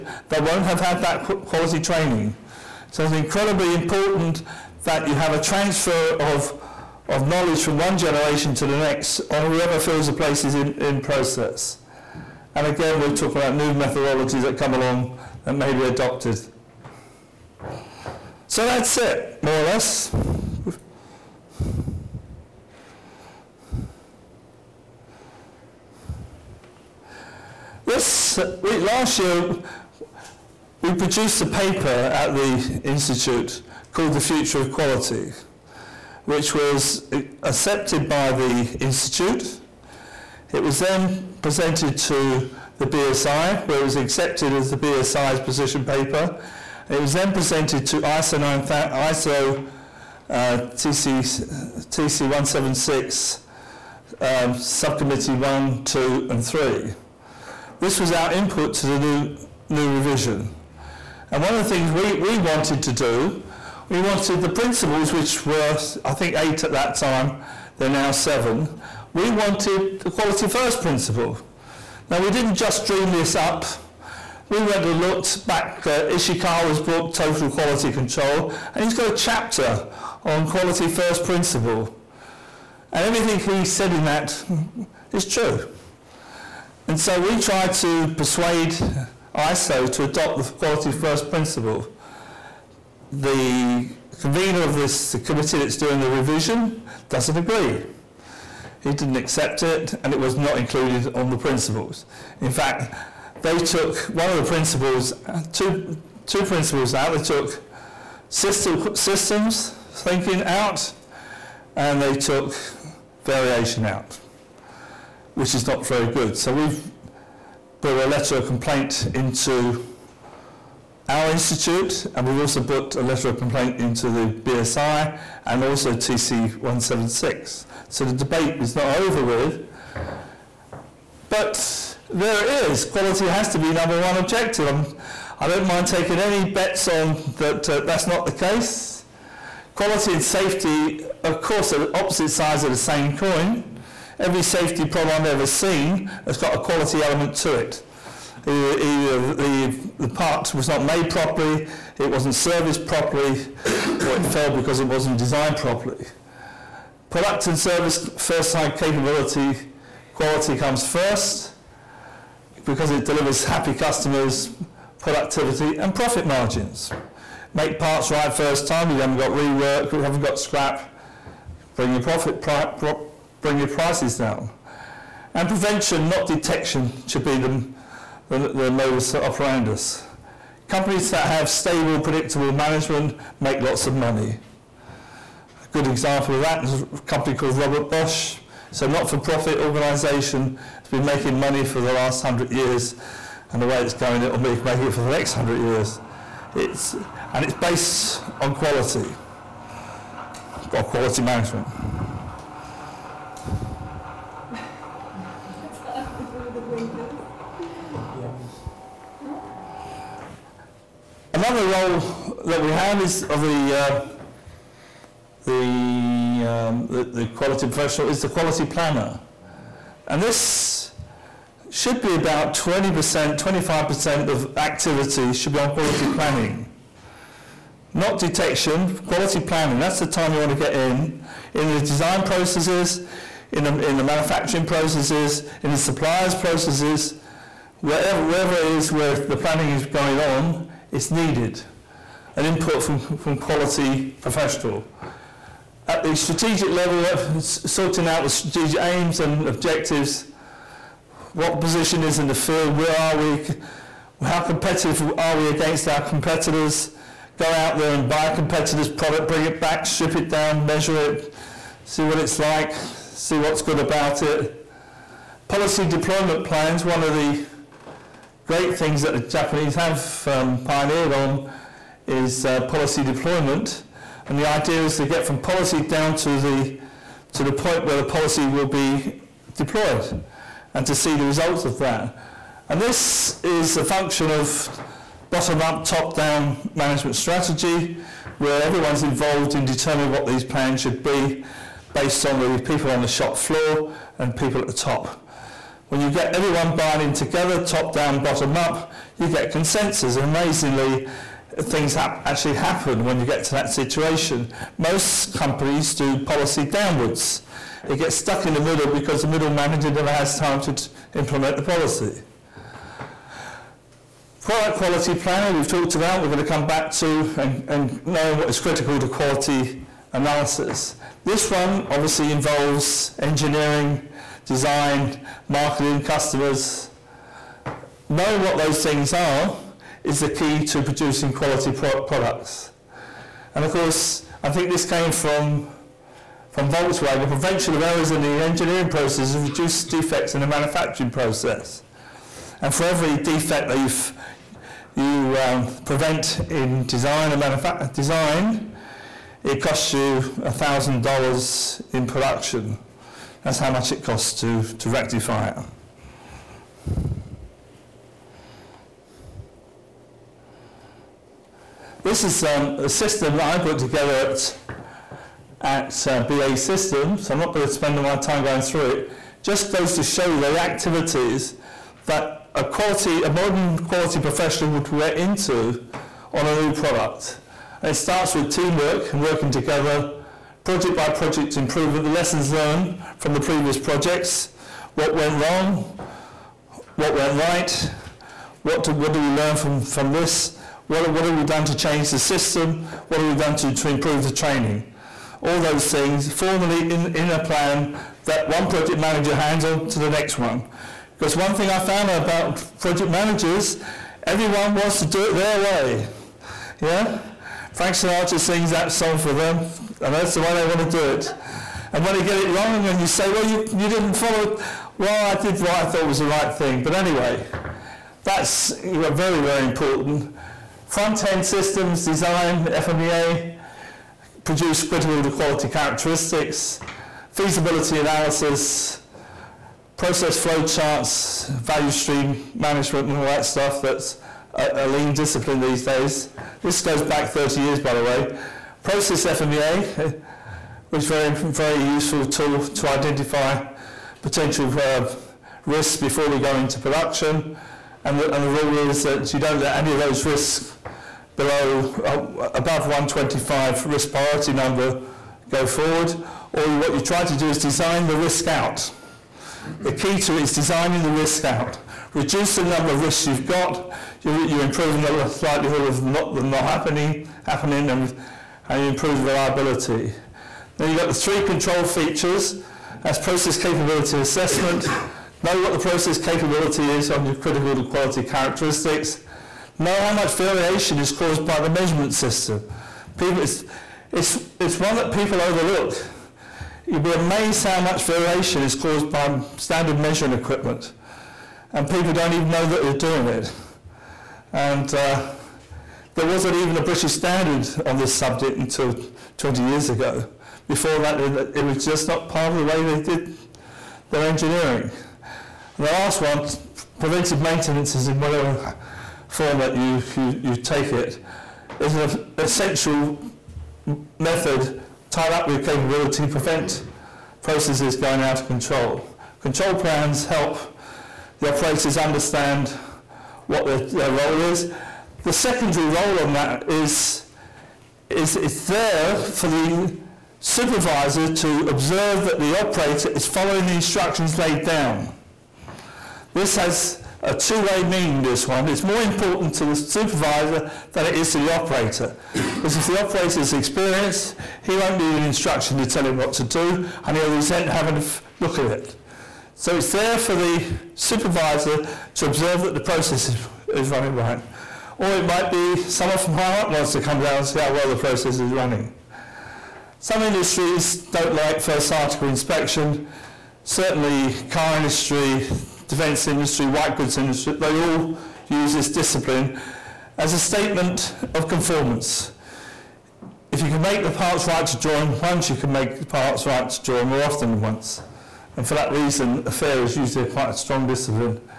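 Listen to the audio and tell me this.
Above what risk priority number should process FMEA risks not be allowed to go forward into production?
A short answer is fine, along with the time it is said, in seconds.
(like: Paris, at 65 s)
125, at 452 s.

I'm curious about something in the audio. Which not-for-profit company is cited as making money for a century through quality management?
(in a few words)
Robert Bosch.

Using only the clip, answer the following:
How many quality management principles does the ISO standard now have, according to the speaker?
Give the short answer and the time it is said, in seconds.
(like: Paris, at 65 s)
7, at 68 s.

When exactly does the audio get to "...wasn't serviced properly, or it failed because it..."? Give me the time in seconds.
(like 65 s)
152 s.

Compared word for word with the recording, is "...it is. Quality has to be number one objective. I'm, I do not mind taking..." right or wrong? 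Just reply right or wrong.
right.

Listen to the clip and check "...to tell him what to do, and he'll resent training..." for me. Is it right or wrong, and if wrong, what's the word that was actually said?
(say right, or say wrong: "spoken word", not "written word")
wrong: "having", not "training".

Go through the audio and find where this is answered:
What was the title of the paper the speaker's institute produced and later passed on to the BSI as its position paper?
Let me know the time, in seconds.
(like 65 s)
34 s.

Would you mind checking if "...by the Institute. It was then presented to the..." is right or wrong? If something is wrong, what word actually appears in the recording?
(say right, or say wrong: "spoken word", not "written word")
right.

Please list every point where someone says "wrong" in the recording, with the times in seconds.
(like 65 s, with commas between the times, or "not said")
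385 s, 412 s.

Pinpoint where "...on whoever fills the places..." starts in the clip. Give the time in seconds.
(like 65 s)
9 s.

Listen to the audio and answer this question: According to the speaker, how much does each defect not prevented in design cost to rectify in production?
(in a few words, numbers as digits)
$1,000.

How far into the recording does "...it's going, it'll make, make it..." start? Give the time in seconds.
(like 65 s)
193 s.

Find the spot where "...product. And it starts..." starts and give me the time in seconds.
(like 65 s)
376 s.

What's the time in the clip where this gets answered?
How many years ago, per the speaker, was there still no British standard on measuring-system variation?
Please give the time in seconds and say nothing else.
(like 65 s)
499 s.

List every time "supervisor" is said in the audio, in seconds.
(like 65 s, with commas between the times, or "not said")
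530 s, 539 s, 550 s.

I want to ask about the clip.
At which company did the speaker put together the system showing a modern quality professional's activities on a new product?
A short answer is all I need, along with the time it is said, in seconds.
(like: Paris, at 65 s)
BAE Systems, at 366 s.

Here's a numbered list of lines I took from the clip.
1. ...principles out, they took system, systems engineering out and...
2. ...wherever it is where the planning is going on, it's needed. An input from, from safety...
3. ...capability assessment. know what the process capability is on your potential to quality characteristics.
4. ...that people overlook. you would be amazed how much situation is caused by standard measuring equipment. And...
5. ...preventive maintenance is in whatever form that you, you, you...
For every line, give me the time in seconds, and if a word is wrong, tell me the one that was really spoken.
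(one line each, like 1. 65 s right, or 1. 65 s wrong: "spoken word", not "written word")
1. 106 s wrong: "thinking", not "engineering"
2. 238 s wrong: "quality", not "safety"
3. 473 s wrong: "critical", not "potential"
4. 484 s wrong: "variation", not "situation"
5. 507 s right.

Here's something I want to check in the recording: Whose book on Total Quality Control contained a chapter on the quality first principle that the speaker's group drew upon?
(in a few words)
Ishikawa.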